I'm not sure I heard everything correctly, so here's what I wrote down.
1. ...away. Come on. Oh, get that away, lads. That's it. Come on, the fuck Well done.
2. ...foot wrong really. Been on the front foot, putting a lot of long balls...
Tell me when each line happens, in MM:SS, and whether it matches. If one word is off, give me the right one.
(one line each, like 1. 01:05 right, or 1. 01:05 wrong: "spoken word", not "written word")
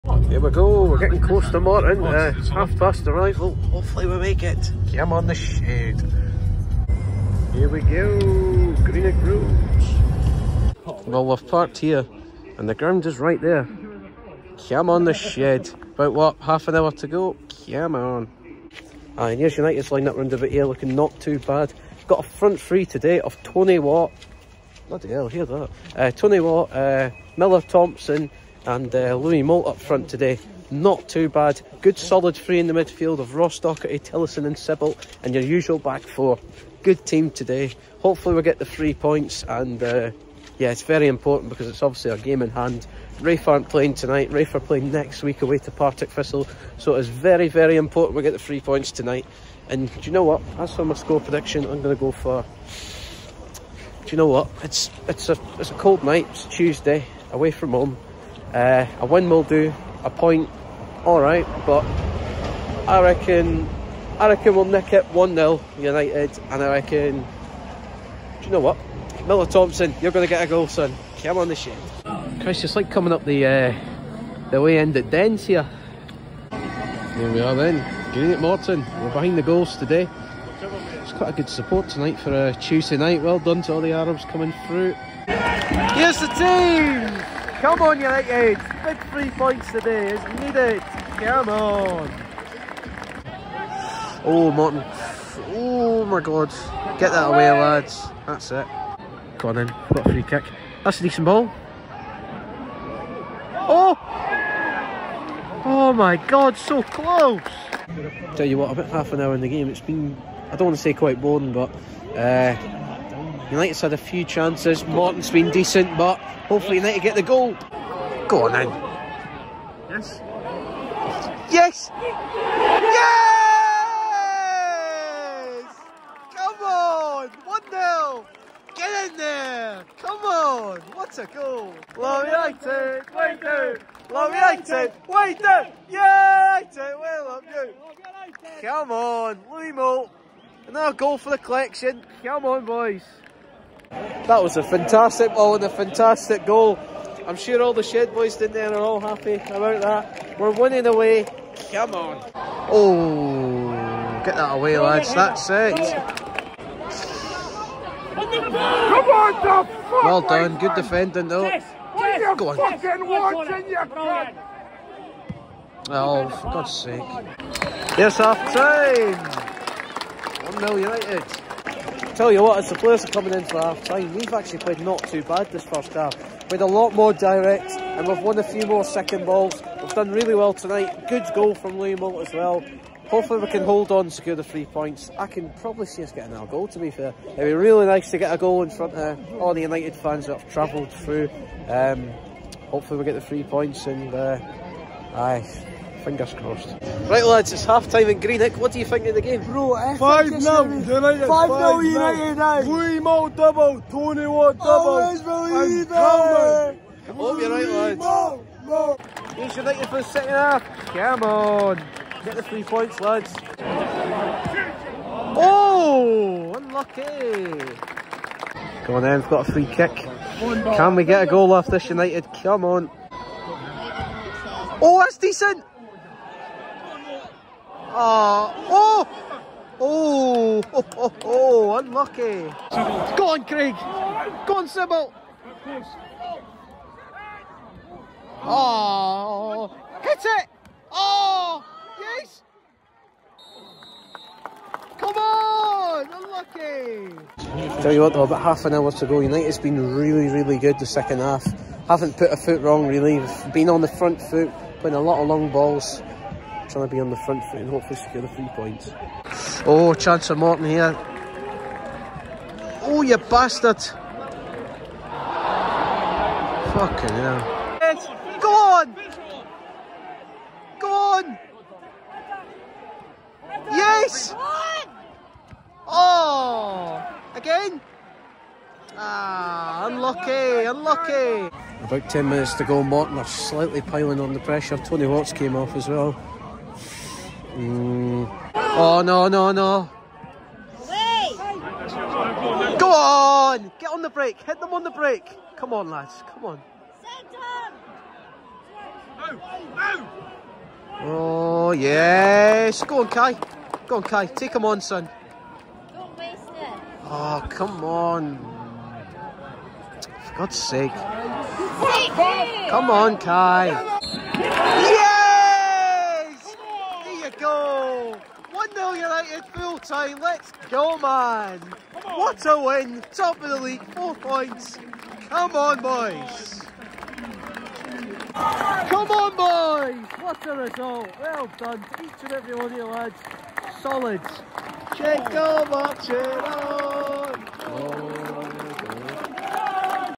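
1. 02:30 right
2. 04:12 right.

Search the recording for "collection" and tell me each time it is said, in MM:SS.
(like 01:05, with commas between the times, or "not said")
02:21.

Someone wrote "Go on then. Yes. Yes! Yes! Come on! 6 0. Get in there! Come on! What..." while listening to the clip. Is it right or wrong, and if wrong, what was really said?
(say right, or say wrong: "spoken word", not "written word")
wrong: "1", not "6".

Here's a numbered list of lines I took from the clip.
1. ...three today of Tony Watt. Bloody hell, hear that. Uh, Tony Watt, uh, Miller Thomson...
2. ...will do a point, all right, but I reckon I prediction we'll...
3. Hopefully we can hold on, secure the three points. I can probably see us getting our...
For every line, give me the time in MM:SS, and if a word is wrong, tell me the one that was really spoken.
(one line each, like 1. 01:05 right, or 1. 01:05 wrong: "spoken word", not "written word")
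1. 00:22 right
2. 00:59 wrong: "reckon", not "prediction"
3. 03:03 right.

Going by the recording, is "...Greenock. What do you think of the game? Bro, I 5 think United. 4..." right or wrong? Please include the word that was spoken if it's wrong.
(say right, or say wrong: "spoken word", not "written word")
wrong: "5", not "4".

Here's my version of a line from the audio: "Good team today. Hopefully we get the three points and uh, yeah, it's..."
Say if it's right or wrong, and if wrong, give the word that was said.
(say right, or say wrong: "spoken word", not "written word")
right.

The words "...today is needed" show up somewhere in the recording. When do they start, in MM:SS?
01:29.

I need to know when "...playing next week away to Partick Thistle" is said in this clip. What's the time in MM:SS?
00:44.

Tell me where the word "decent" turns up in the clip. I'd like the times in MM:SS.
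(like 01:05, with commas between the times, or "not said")
01:41, 01:55, 03:45.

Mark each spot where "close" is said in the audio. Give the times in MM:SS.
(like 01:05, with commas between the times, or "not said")
00:01, 01:46.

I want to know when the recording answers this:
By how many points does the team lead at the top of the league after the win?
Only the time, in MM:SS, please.
05:23.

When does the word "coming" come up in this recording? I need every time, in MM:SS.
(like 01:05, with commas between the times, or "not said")
01:12, 01:24, 02:53.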